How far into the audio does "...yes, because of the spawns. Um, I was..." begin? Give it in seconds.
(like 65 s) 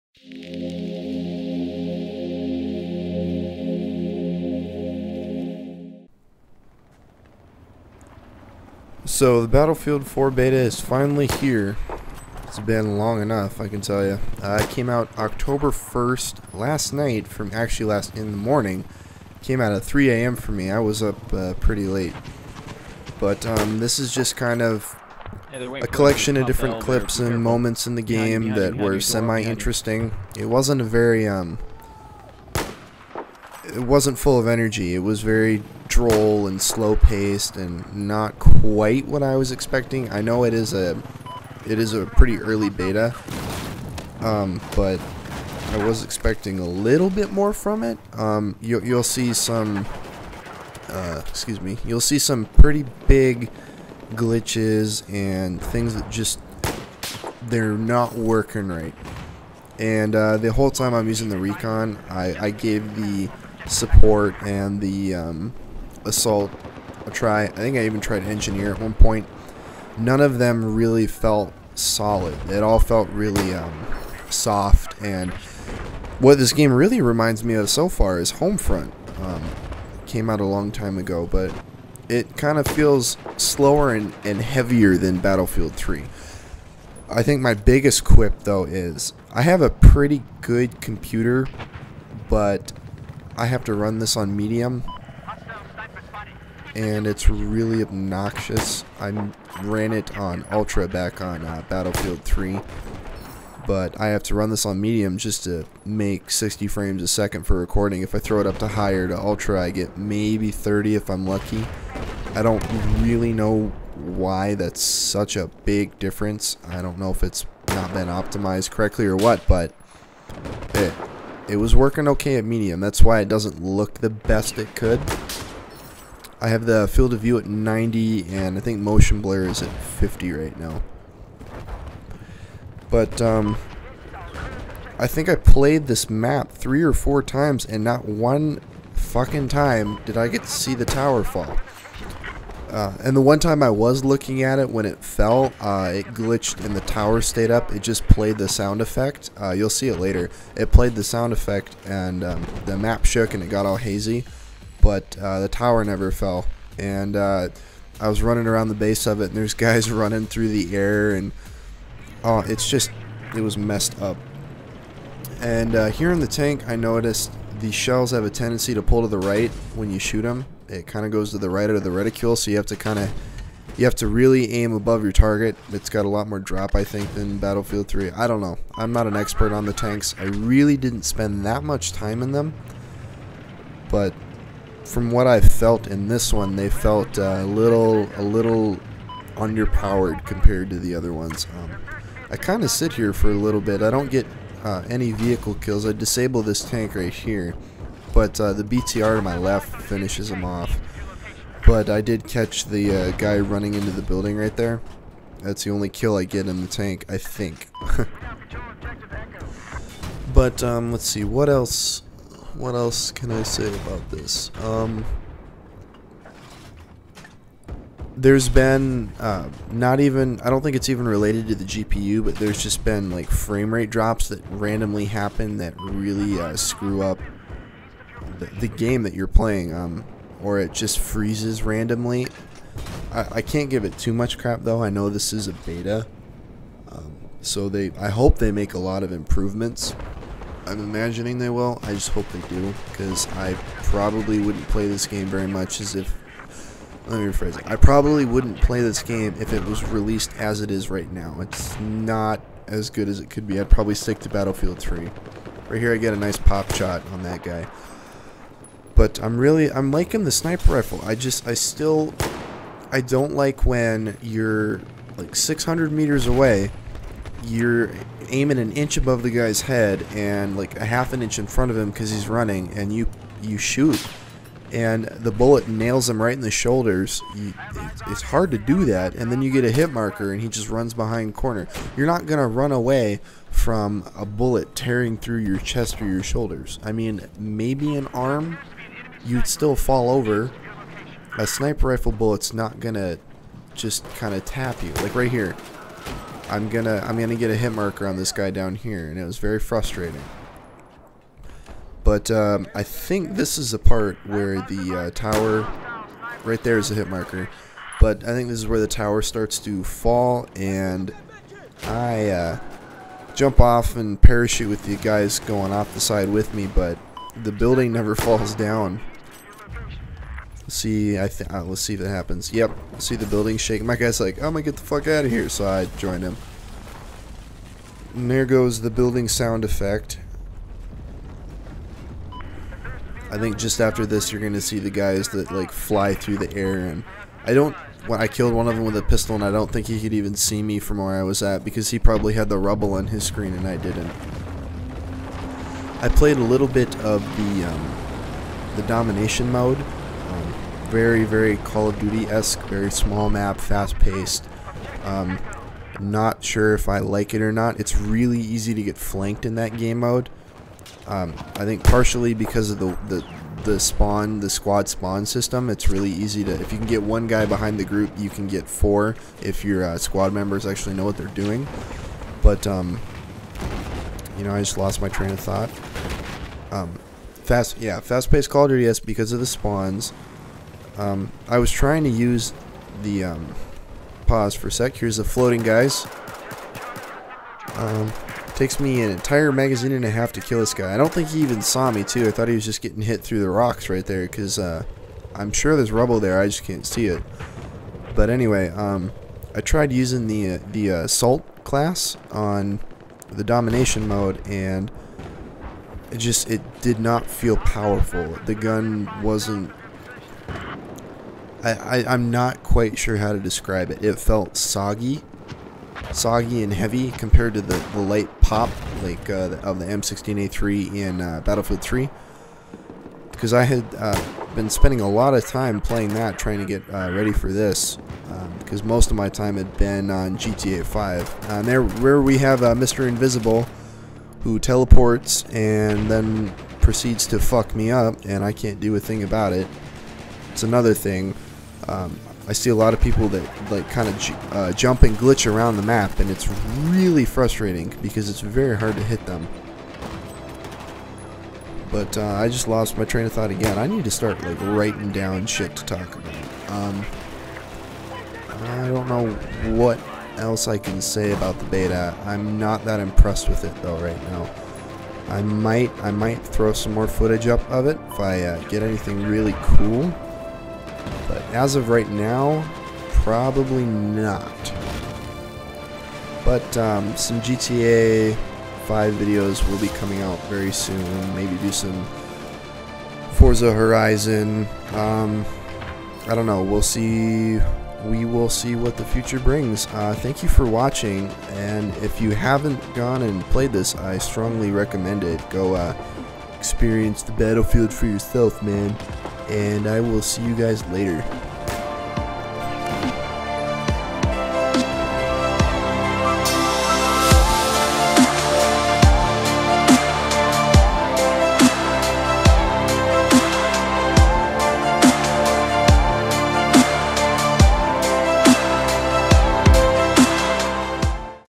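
378 s.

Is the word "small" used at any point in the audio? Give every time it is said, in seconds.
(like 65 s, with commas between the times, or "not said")
352 s.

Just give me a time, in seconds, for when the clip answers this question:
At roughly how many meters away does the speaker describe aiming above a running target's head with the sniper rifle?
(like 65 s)
265 s.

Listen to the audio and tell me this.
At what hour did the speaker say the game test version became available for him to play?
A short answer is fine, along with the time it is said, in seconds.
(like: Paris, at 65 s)
3 a.m., at 19 s.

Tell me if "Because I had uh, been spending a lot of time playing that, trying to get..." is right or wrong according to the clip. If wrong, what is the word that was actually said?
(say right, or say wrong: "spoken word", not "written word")
right.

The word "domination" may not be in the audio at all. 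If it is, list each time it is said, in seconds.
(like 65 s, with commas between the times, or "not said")
348 s, 403 s.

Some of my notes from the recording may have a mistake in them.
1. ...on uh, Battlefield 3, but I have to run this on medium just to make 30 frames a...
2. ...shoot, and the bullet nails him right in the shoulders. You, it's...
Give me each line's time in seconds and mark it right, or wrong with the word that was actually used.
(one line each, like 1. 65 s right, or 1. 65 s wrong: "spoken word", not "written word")
1. 101 s wrong: "60", not "30"
2. 273 s right.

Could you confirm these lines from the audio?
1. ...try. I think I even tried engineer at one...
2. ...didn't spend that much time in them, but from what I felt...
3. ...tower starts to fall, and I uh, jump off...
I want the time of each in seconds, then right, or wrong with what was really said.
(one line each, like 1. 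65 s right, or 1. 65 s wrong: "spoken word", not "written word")
1. 67 s right
2. 180 s right
3. 308 s right.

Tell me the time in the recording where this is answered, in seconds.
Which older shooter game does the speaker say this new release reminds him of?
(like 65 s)
78 s.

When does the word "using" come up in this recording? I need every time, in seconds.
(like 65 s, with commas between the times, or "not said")
61 s, 399 s.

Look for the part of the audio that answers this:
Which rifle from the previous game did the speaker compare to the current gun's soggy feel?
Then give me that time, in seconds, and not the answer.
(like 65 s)
419 s.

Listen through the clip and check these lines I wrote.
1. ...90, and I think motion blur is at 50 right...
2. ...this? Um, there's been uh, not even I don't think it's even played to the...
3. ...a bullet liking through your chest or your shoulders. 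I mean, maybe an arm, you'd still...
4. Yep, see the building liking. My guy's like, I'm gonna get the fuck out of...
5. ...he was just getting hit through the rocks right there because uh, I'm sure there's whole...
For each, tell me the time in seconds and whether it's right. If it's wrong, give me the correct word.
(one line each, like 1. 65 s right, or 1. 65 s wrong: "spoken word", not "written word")
1. 127 s right
2. 214 s wrong: "related", not "played"
3. 284 s wrong: "tearing", not "liking"
4. 322 s wrong: "shaking", not "liking"
5. 392 s wrong: "rubble", not "whole".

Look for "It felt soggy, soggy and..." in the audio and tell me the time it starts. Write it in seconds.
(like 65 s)
414 s.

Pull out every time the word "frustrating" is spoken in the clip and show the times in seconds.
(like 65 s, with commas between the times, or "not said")
299 s, 447 s.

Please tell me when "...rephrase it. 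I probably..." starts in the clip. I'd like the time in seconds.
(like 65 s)
247 s.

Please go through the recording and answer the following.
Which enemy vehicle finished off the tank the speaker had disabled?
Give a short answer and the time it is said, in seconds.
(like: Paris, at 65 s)
BTR, at 198 s.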